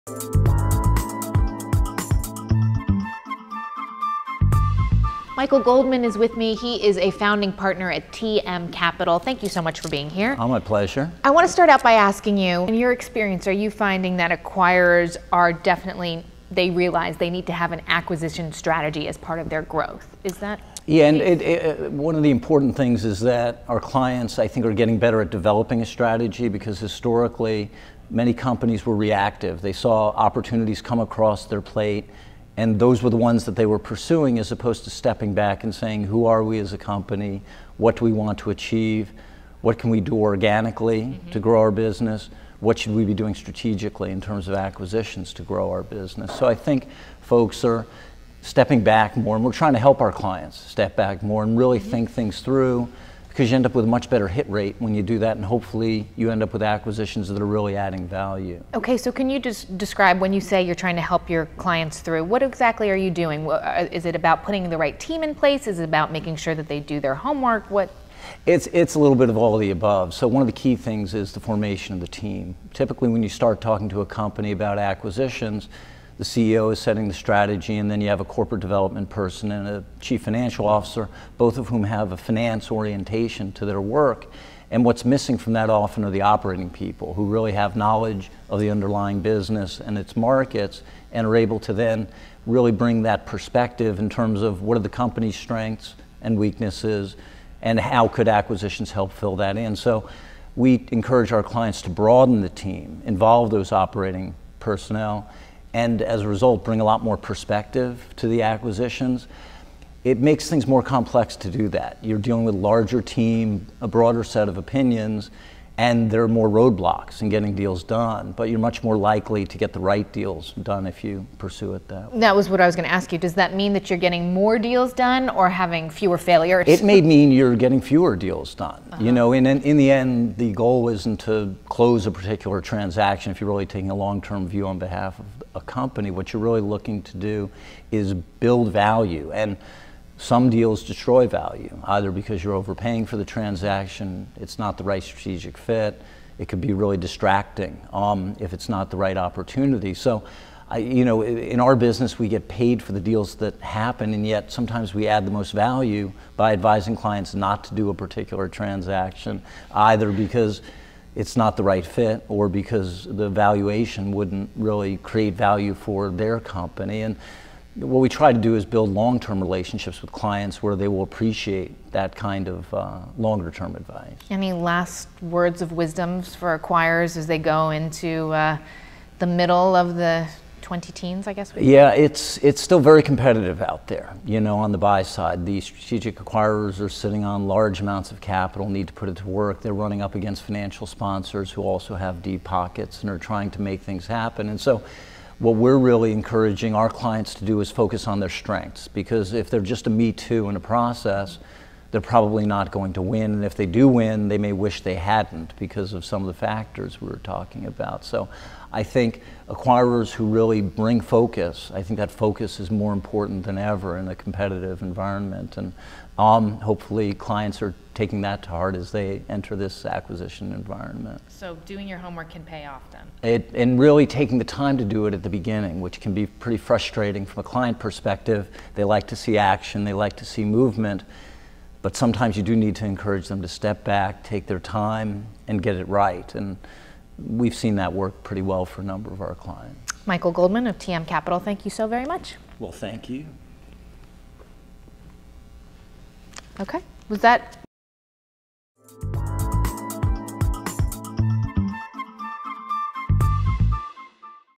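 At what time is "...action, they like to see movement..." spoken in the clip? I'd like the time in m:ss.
3:49.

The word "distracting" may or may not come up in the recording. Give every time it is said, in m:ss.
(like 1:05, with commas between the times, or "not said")
2:26.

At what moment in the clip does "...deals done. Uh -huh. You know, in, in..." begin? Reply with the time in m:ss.
2:08.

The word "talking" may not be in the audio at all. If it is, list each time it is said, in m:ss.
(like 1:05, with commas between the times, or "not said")
1:13, 3:27.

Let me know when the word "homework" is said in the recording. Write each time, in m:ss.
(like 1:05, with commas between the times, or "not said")
1:07, 3:41.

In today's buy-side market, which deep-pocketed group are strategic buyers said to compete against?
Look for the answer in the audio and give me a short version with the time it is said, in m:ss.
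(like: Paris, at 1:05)
Financial sponsors, at 3:10.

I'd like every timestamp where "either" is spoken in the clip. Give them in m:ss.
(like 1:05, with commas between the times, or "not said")
2:21, 2:39.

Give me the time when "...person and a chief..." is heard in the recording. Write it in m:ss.
1:19.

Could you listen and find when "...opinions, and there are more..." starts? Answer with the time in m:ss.
1:54.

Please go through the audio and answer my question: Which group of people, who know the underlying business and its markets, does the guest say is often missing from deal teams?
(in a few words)
Operating people.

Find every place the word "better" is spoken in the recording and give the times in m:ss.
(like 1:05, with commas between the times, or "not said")
0:24, 0:54.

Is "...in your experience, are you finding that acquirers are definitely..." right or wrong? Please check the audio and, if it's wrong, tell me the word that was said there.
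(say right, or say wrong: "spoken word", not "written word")
right.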